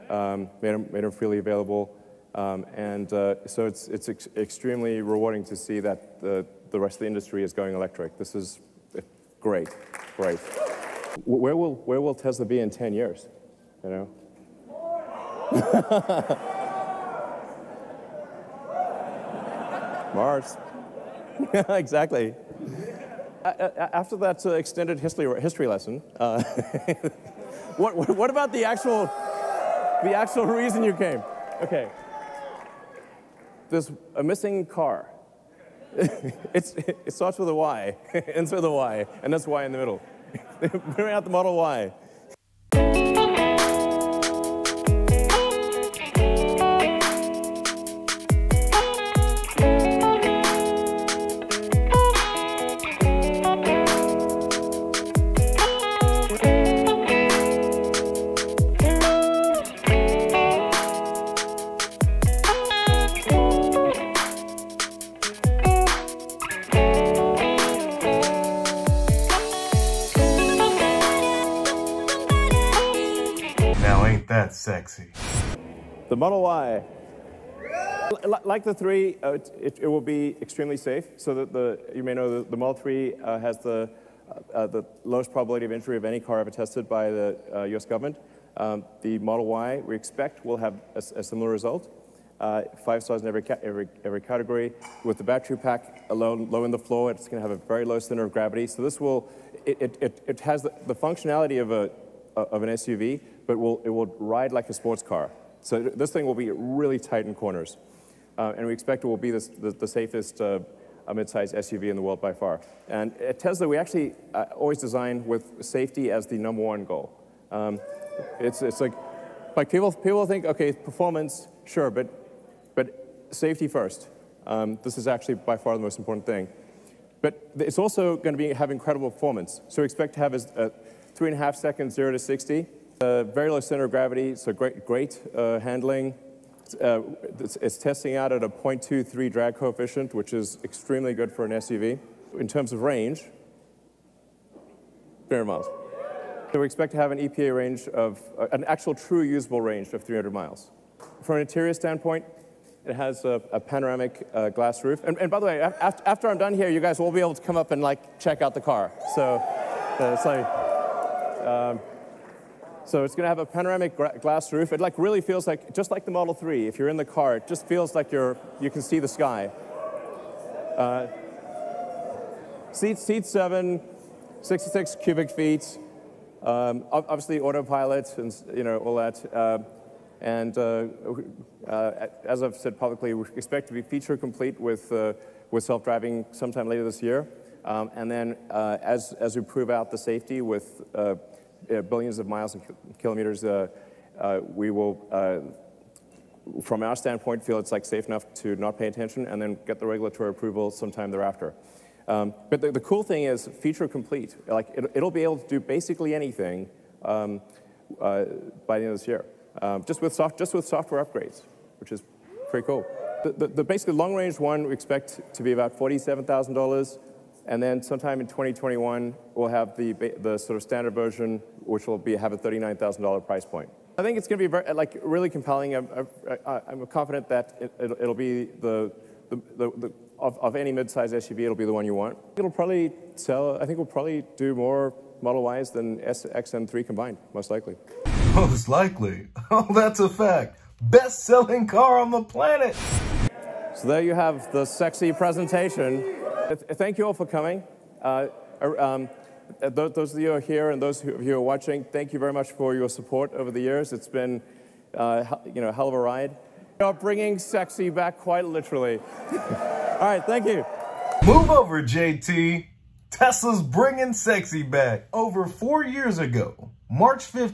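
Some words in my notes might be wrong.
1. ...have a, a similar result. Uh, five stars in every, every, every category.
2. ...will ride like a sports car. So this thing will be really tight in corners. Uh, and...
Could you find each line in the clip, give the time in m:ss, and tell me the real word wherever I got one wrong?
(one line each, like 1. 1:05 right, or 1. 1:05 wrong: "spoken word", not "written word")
1. 1:30 right
2. 1:43 right.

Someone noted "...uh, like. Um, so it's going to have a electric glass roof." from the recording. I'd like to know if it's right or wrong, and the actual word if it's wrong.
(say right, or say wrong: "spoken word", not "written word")
wrong: "panoramic", not "electric".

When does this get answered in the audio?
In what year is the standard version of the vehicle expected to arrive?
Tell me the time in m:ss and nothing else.
3:38.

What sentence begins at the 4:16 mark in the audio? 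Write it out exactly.
You are bringing sexy back quite literally.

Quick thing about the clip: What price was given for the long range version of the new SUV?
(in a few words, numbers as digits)
$47,000.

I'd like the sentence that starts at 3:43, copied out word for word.
I think it's going to be very, like really compelling.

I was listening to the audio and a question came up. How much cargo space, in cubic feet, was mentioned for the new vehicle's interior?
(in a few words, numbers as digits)
66 cubic feet.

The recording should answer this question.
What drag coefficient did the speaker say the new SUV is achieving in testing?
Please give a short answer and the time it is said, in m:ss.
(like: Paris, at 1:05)
0.23, at 2:18.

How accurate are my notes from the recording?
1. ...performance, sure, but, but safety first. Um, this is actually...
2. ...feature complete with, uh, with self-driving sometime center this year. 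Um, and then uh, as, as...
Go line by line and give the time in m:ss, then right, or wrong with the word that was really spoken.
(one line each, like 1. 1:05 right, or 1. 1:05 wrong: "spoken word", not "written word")
1. 2:00 right
2. 3:03 wrong: "later", not "center".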